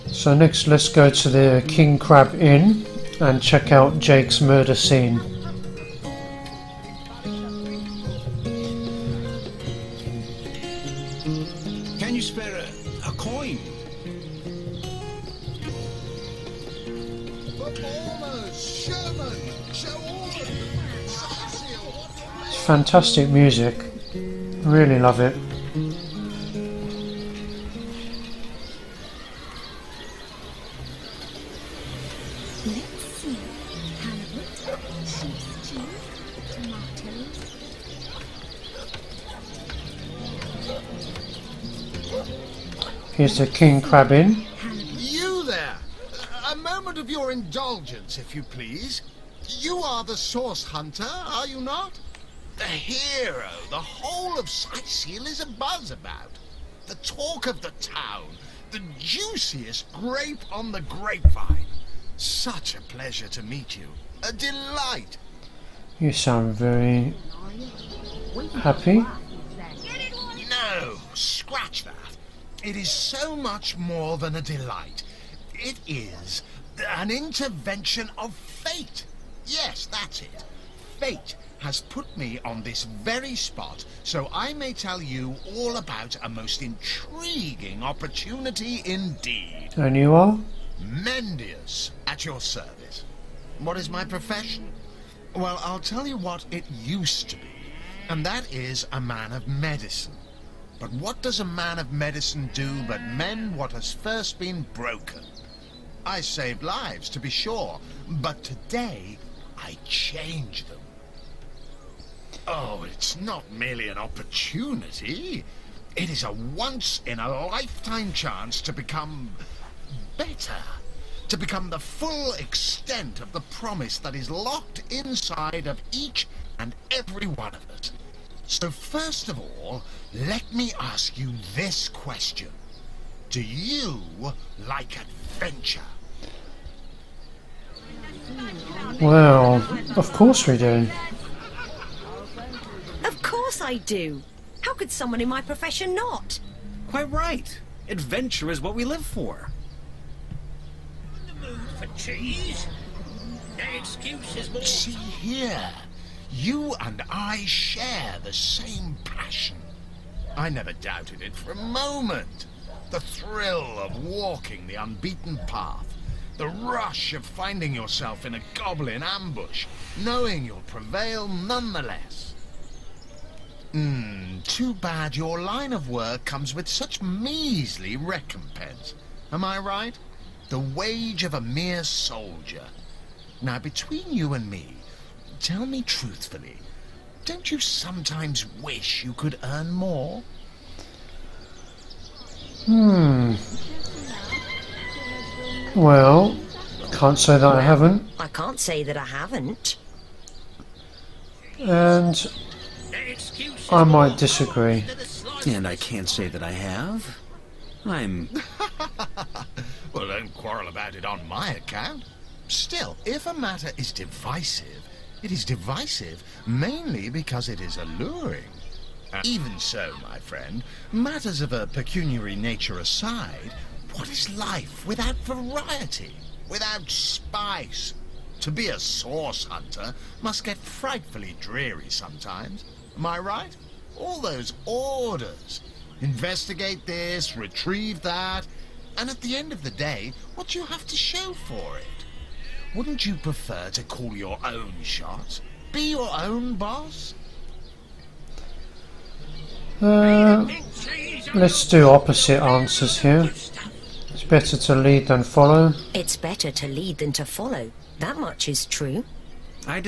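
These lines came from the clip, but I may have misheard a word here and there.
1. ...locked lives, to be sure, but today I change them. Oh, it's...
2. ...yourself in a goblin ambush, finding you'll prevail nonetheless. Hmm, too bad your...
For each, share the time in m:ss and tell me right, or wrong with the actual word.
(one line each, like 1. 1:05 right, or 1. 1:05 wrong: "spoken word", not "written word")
1. 1:46 wrong: "saved", not "locked"
2. 2:47 wrong: "knowing", not "finding".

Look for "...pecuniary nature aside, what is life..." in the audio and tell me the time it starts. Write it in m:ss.
3:41.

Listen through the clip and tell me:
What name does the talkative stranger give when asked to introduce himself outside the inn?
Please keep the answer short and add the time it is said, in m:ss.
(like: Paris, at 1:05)
Mendius, at 1:30.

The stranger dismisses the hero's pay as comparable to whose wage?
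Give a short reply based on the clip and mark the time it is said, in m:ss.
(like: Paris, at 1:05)
a mere soldier, at 3:01.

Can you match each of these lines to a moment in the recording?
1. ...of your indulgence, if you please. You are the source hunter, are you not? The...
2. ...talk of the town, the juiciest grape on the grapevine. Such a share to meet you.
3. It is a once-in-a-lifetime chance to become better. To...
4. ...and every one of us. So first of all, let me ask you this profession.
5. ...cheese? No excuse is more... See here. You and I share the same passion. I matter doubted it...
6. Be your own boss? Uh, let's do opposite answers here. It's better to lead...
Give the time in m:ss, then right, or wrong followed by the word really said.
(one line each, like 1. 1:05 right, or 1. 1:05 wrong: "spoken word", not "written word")
1. 0:46 right
2. 0:56 wrong: "pleasure", not "share"
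3. 1:55 right
4. 2:06 wrong: "question", not "profession"
5. 2:31 wrong: "never", not "matter"
6. 4:05 right.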